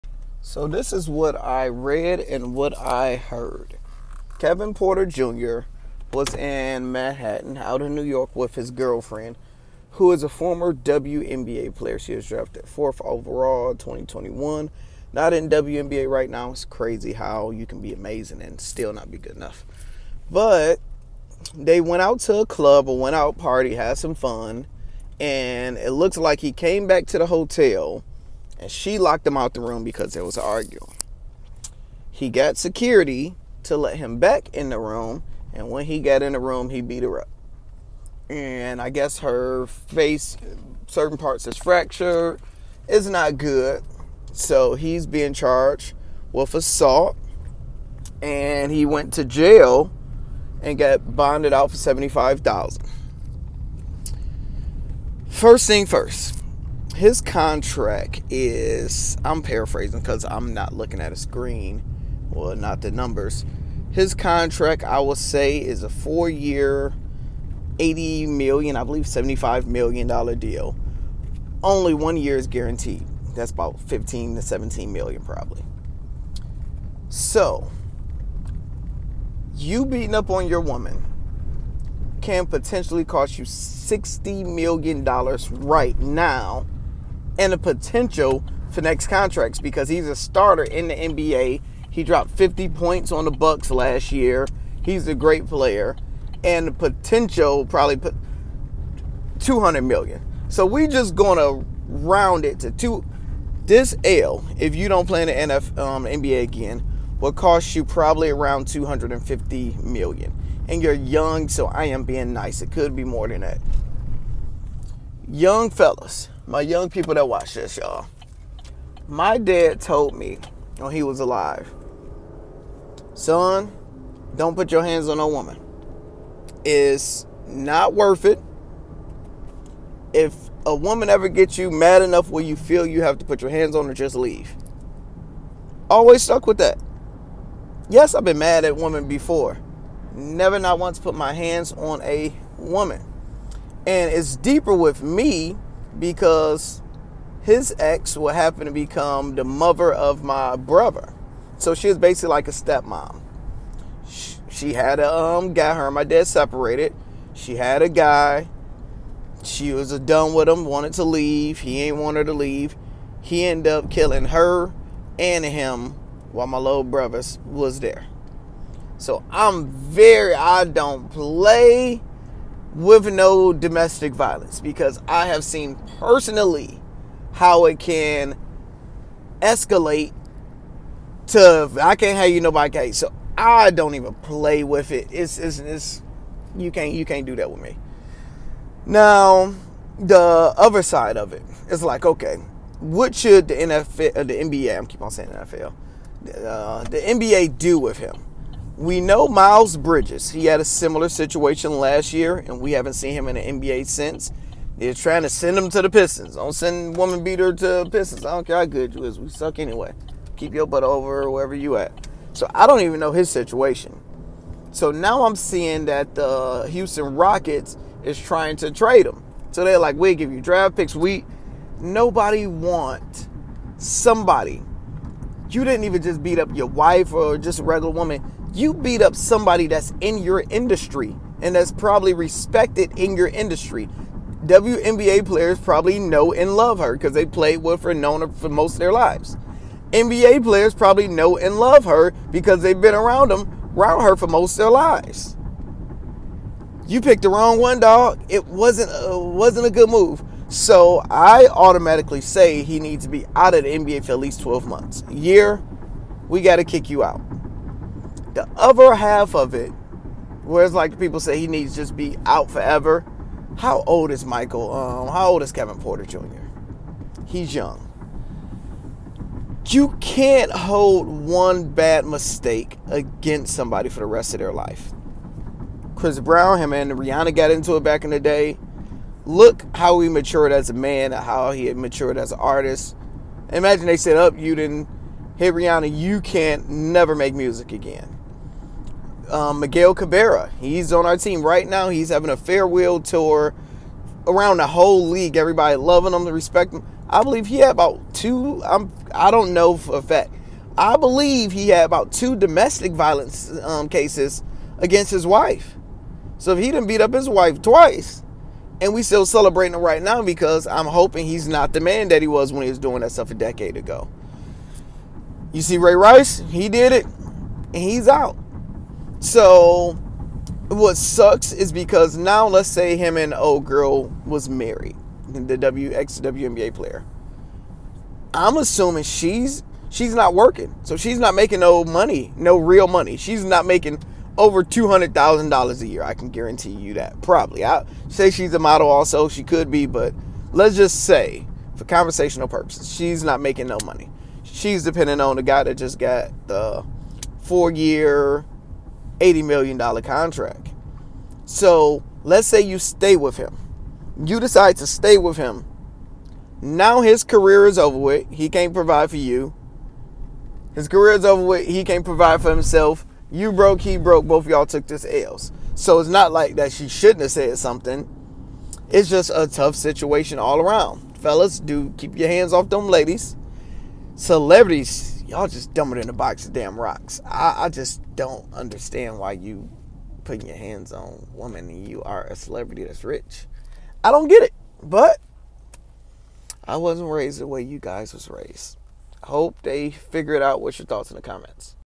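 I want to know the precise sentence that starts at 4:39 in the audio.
Look how he matured as a man, how he matured as an artist.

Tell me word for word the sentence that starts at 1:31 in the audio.
He dropped 50 points on the Bucks last year.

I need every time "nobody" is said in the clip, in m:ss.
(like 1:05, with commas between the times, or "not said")
3:02, 3:41.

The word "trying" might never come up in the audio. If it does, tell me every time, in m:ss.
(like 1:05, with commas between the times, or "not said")
3:24, 3:38.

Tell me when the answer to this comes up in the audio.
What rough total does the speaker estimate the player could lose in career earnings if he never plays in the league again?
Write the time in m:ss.
1:48.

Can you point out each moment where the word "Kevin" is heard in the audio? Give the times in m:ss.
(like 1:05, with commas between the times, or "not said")
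0:04, 4:25.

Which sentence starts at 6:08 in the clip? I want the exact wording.
It's just a tough situation all around.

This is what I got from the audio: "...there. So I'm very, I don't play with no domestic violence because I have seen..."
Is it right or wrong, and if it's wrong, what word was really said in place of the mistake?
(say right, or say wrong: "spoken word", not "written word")
right.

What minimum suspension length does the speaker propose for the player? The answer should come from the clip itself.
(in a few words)
12 months.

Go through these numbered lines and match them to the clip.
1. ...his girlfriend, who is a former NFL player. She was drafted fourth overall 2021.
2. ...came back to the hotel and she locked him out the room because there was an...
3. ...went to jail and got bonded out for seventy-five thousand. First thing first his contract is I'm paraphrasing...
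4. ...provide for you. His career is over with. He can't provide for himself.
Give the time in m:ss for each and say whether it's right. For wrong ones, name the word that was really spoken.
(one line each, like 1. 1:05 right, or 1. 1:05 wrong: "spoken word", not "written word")
1. 0:08 wrong: "WNBA", not "NFL"
2. 0:26 right
3. 0:48 right
4. 5:58 right.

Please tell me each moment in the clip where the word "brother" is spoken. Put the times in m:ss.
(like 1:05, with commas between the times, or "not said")
2:30, 2:46.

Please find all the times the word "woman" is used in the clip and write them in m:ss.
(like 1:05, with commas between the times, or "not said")
1:20, 2:05, 2:10, 2:22, 3:26, 3:47, 6:21.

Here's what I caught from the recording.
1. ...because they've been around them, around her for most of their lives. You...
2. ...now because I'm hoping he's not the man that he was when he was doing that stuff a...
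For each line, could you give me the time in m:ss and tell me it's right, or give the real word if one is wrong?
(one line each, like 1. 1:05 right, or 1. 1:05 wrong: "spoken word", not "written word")
1. 4:02 right
2. 5:10 right.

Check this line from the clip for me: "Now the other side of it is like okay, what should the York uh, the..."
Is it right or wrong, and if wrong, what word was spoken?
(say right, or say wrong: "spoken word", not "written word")
wrong: "NFL", not "York".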